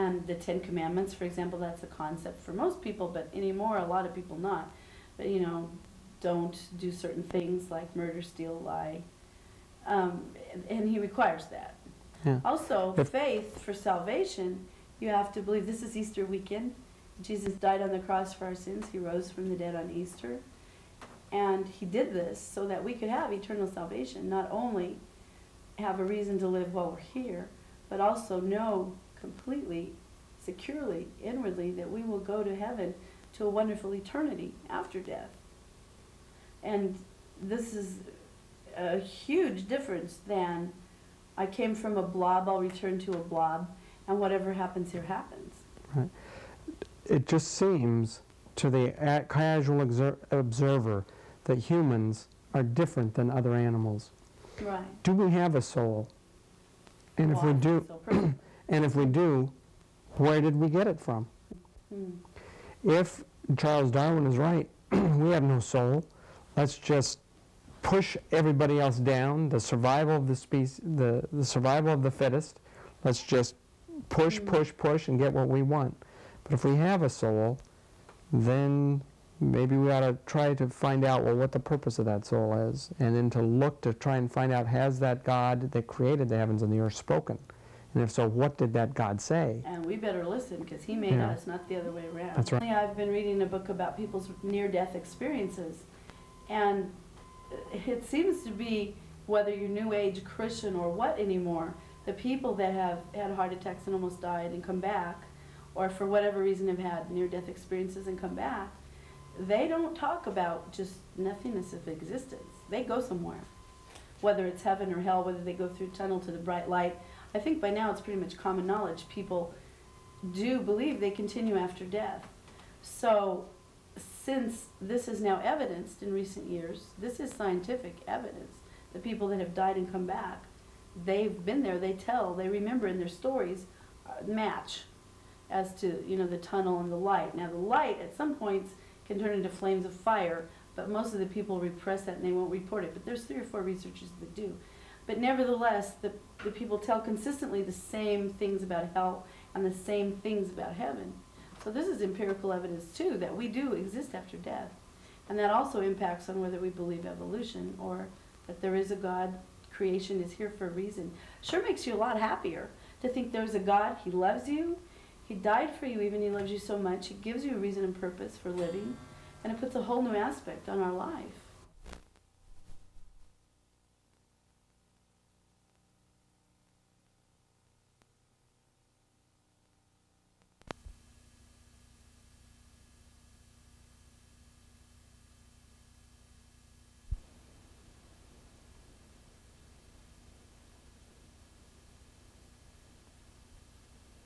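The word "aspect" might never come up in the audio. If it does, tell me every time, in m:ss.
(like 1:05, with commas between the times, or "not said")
2:50.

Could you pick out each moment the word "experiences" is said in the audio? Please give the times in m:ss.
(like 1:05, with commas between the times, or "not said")
1:34, 1:47.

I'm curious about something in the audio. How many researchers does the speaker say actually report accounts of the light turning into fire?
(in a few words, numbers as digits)
3 or 4.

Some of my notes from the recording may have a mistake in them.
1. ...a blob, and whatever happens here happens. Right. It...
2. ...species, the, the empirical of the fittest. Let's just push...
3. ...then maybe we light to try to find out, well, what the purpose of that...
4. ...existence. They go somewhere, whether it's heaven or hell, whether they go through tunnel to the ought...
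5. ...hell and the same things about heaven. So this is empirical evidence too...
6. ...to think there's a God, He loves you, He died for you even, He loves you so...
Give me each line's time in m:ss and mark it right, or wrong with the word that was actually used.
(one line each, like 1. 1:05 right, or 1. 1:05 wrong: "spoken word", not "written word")
1. 0:43 right
2. 1:10 wrong: "survival", not "empirical"
3. 1:18 wrong: "ought", not "light"
4. 1:51 wrong: "bright", not "ought"
5. 2:28 right
6. 2:43 right.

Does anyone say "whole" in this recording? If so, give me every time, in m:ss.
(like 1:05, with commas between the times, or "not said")
2:49.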